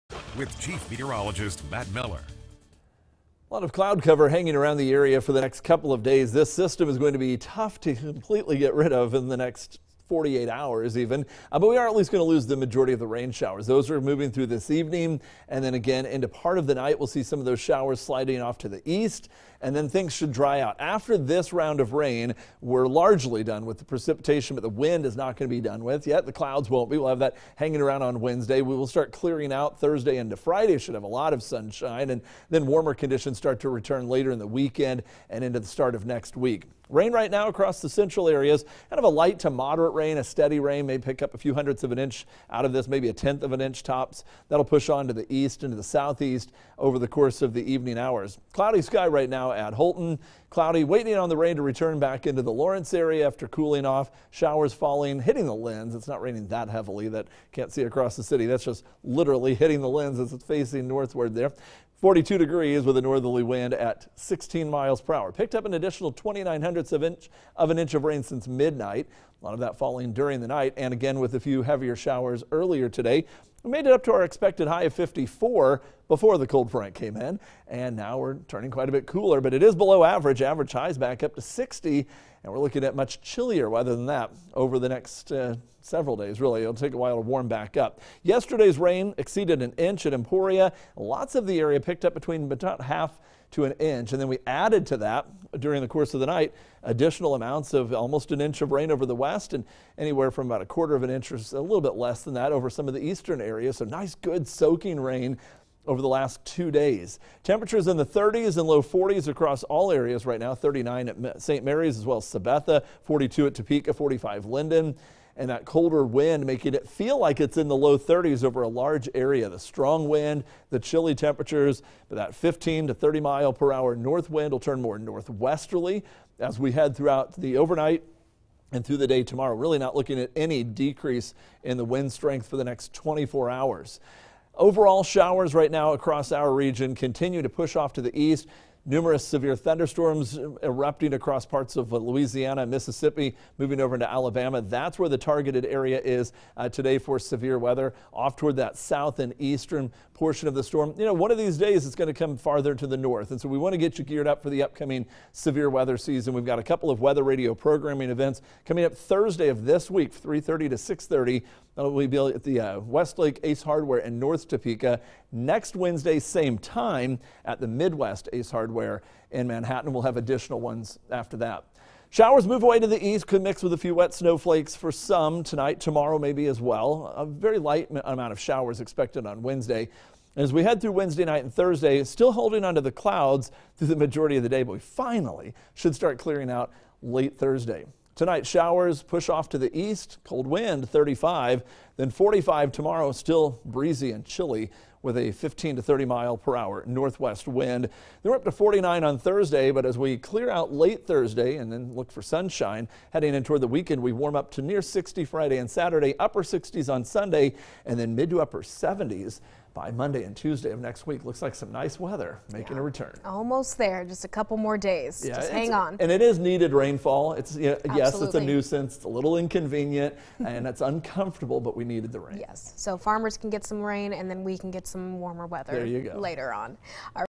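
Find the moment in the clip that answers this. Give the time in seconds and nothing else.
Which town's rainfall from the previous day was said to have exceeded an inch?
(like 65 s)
90 s.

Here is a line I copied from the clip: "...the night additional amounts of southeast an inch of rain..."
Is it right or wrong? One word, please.
wrong.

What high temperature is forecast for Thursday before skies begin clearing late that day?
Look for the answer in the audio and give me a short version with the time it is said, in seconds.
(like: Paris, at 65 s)
49, at 198 s.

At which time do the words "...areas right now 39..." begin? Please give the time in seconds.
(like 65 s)
109 s.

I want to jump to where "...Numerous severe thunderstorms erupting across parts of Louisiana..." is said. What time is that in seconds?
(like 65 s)
138 s.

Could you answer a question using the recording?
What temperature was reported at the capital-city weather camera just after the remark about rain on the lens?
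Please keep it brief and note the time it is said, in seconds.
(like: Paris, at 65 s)
42 degrees, at 62 s.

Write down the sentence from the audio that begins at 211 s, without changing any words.
Looks like some nice weather making yeah.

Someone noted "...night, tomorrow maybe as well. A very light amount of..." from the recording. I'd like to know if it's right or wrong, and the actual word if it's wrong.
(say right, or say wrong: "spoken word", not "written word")
wrong: "tonight", not "night".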